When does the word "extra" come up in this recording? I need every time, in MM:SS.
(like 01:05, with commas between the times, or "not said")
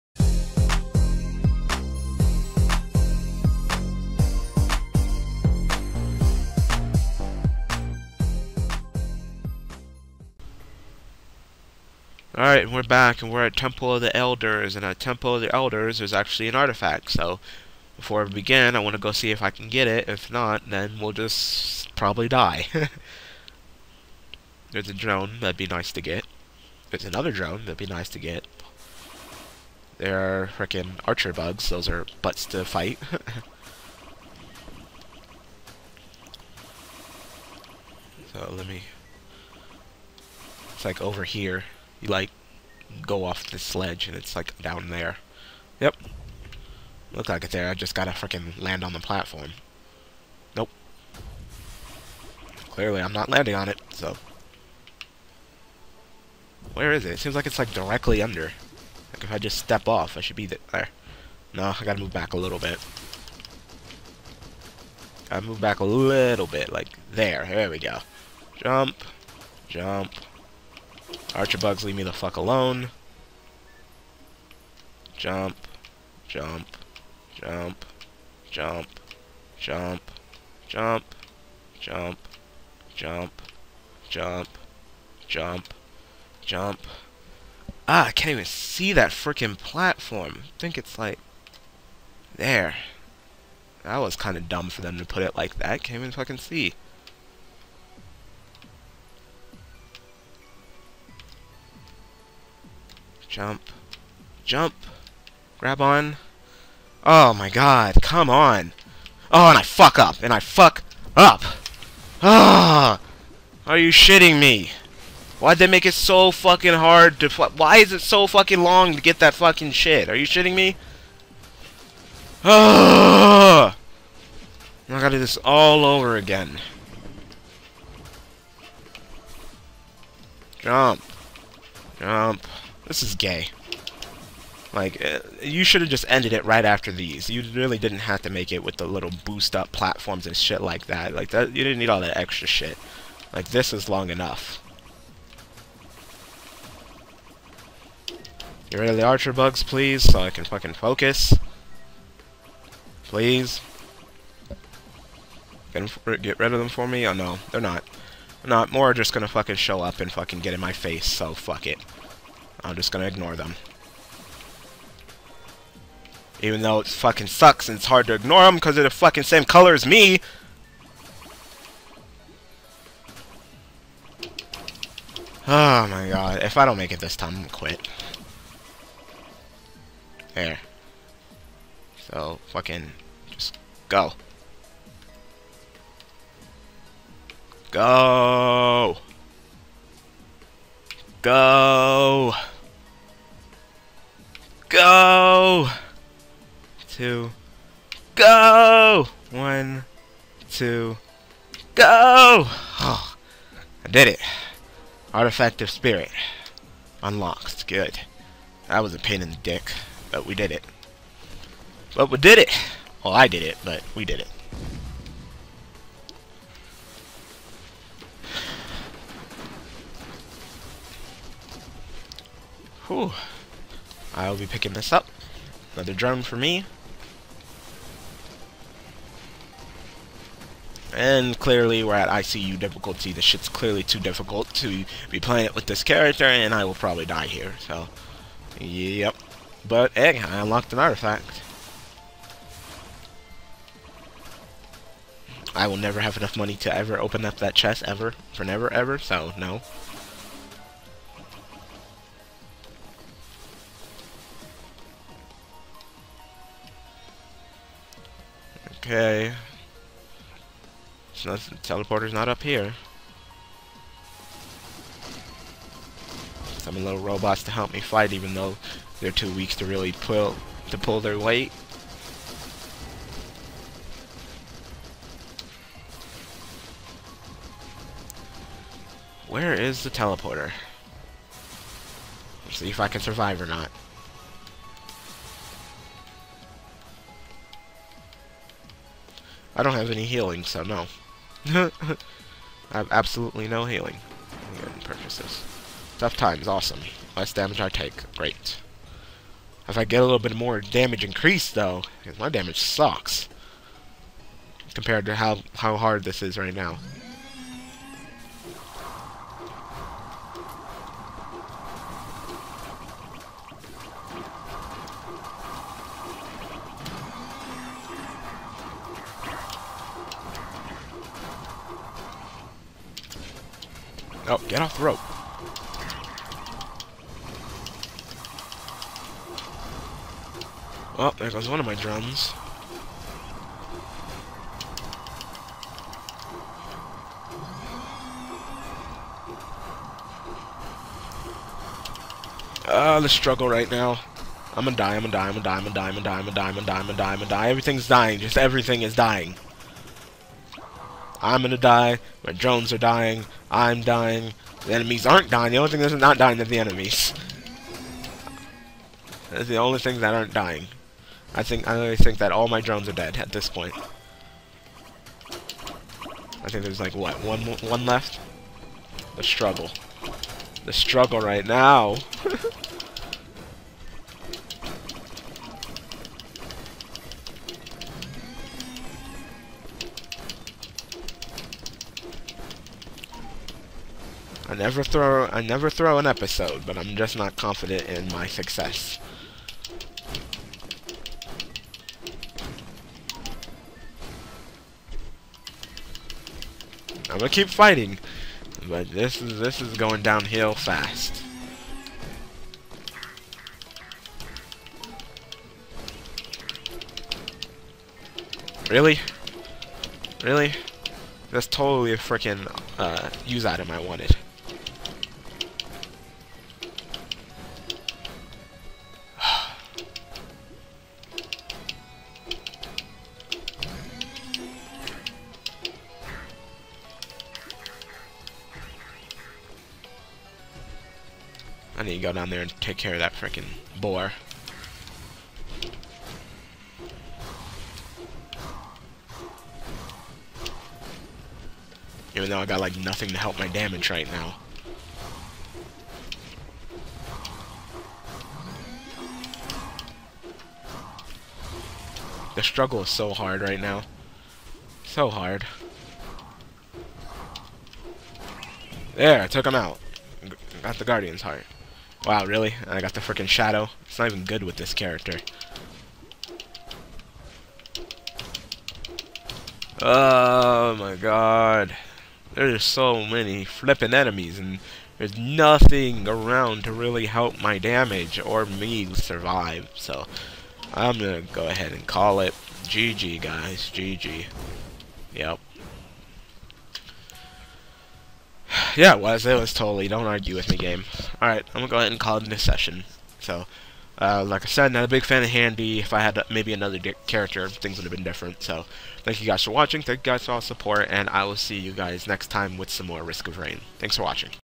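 02:22.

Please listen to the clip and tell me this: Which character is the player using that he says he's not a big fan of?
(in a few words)
Han-D.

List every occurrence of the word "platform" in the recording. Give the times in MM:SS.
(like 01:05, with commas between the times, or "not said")
00:48, 01:29, 02:19.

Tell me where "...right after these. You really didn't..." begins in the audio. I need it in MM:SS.
02:16.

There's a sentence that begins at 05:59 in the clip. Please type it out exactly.
That's the only thing that aren't dying.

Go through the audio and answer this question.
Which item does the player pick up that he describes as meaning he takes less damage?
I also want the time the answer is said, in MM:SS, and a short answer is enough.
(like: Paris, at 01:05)
Tough Times, at 04:55.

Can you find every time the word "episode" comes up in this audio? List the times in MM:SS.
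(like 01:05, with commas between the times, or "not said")
06:26.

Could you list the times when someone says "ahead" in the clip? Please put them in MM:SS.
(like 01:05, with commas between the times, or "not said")
08:01, 08:11.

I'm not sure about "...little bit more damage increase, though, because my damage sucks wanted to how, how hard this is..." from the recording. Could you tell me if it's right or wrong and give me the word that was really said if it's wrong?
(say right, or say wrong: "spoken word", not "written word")
wrong: "compared", not "wanted".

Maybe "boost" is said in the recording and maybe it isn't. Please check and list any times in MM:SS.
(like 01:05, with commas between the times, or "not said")
02:19.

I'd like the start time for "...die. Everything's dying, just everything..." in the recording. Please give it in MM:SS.
05:47.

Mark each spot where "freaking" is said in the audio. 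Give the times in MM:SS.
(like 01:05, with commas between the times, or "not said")
00:48, 01:29, 06:51, 07:13, 07:42.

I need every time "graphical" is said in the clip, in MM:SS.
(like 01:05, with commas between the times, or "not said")
not said.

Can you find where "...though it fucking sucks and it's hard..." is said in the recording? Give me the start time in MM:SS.
02:46.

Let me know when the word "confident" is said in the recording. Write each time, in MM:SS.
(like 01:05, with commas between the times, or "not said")
06:27.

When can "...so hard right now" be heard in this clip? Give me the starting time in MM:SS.
07:32.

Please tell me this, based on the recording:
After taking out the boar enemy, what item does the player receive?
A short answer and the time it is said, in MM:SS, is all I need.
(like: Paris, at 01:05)
Guardian's heart, at 07:40.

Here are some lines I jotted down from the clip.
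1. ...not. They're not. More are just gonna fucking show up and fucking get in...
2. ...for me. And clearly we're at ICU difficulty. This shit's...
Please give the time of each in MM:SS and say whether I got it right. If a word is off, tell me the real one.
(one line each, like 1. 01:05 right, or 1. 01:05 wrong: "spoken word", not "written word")
1. 02:37 right
2. 03:46 right.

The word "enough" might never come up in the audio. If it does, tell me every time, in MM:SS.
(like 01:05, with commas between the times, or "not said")
02:24, 04:06.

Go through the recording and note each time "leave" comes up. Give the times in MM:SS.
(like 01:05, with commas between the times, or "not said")
01:11.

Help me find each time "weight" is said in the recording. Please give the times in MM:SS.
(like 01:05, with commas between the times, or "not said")
04:31.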